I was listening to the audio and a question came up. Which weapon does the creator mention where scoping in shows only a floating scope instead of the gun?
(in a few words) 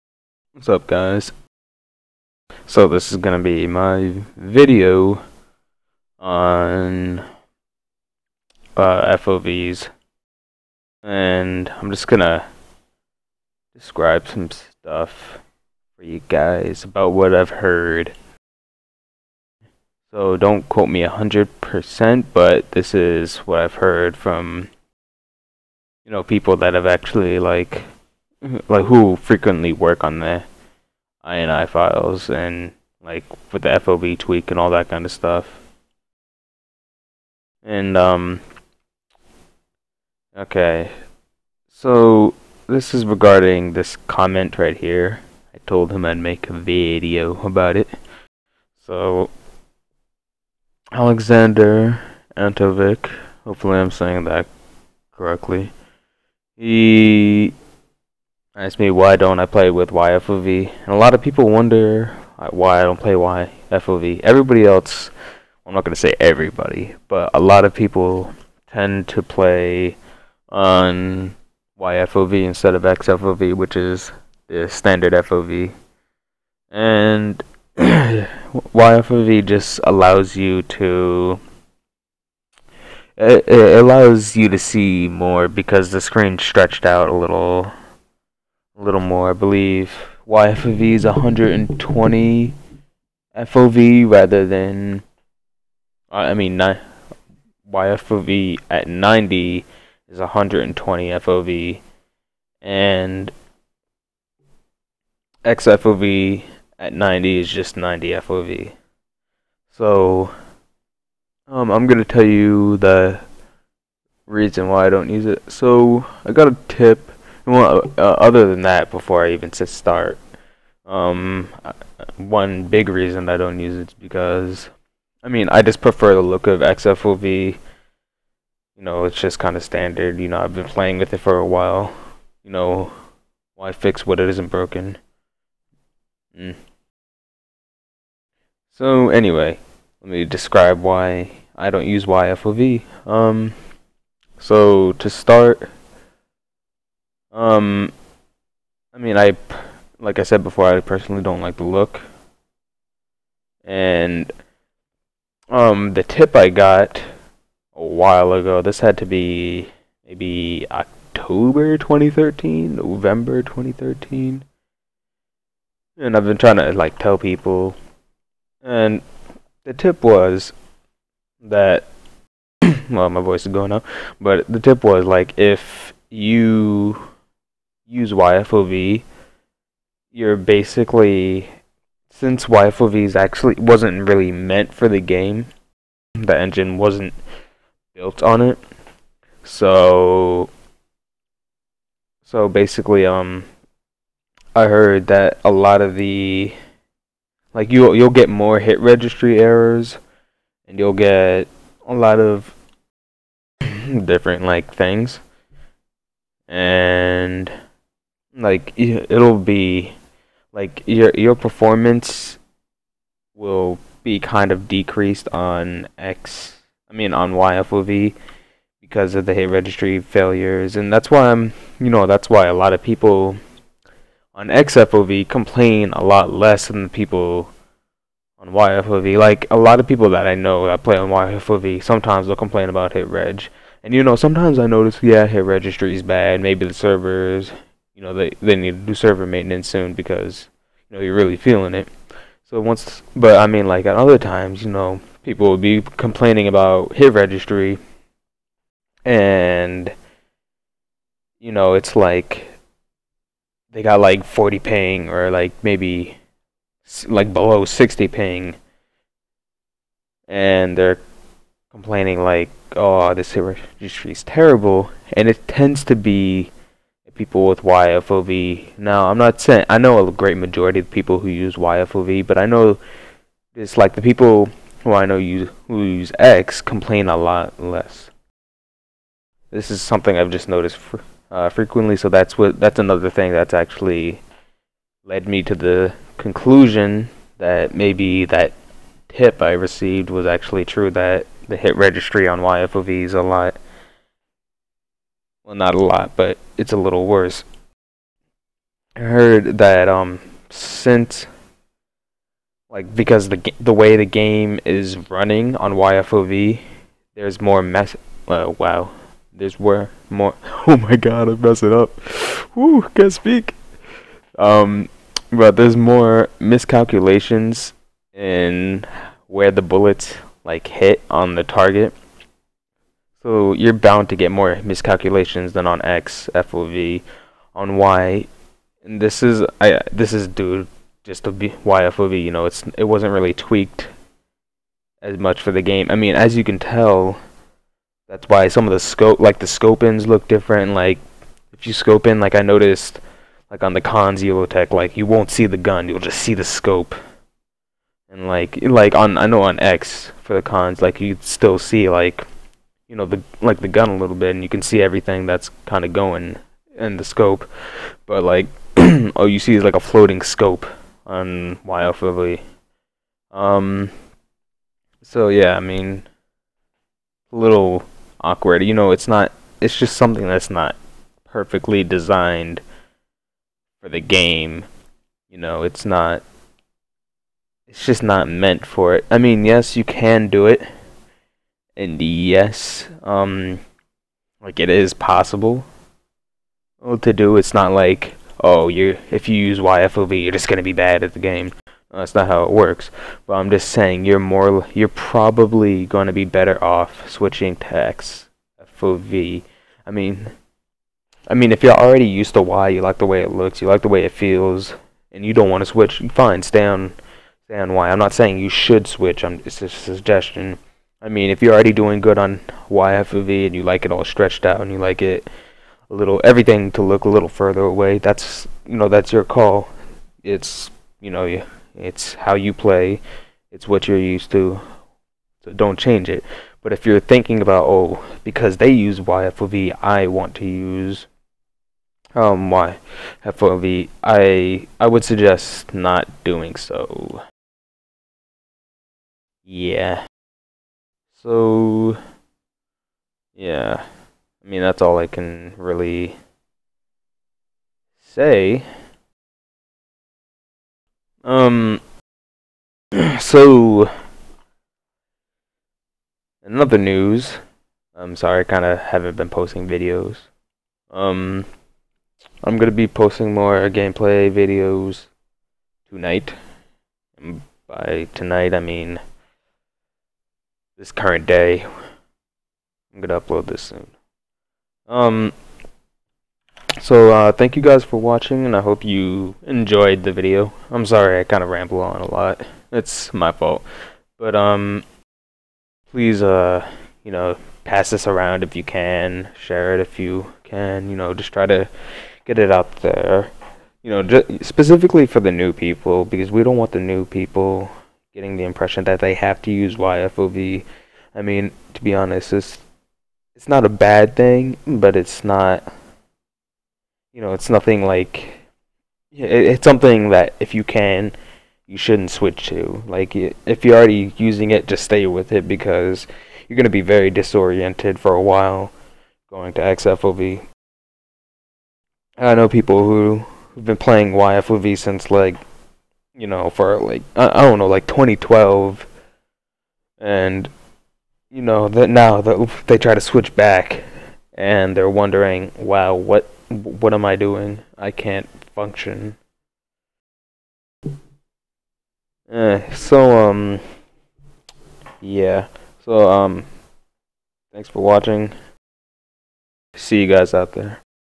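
Khan's tech.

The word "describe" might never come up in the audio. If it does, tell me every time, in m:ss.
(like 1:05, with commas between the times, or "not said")
0:13, 2:20.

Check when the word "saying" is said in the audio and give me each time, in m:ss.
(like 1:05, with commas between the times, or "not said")
0:53, 4:29, 6:33, 6:48.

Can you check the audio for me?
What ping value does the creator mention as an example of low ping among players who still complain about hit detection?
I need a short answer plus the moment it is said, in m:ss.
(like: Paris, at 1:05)
40, at 4:14.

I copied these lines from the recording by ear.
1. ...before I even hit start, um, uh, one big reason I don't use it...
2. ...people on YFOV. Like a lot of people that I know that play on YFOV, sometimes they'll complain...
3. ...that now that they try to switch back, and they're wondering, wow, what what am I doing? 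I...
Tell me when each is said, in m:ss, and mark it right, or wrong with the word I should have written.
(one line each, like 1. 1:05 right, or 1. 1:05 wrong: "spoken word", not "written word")
1. 1:58 right
2. 3:46 right
3. 8:51 right.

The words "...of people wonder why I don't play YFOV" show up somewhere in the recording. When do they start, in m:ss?
1:01.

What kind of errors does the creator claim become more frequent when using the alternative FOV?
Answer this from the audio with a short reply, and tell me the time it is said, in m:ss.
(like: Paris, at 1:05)
hit registry errors, at 3:18.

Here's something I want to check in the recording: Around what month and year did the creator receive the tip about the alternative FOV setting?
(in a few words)
October 2013.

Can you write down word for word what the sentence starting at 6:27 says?
It's not like oh, you if you use YFOV, you're just gonna be bad at the game.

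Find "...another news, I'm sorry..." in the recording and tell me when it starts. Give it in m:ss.
7:36.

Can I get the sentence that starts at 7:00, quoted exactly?
It's you know it's how you play, it's what you're used to.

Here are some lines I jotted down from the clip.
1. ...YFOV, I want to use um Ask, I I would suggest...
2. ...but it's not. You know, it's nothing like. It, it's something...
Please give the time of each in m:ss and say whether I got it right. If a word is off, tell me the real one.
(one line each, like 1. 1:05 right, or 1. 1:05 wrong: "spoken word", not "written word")
1. 7:08 wrong: "YFOV", not "Ask"
2. 8:24 right.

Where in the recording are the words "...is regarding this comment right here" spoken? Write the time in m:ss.
0:42.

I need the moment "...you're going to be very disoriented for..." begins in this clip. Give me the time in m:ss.
8:36.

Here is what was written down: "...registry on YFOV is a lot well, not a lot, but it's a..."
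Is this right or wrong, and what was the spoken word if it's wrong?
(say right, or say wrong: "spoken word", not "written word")
right.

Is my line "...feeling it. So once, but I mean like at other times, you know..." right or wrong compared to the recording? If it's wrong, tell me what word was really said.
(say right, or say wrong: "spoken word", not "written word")
right.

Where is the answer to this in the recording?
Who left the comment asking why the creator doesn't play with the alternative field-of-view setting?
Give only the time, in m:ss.
0:50.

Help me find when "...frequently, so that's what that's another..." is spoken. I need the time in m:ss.
4:41.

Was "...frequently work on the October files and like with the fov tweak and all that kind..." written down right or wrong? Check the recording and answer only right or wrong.
wrong.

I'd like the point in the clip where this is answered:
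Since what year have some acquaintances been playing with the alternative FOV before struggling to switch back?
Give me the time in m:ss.
8:47.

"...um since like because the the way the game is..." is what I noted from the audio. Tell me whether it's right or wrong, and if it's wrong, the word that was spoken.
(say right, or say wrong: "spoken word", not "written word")
right.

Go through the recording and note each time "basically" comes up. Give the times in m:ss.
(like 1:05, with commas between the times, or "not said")
3:00, 3:12.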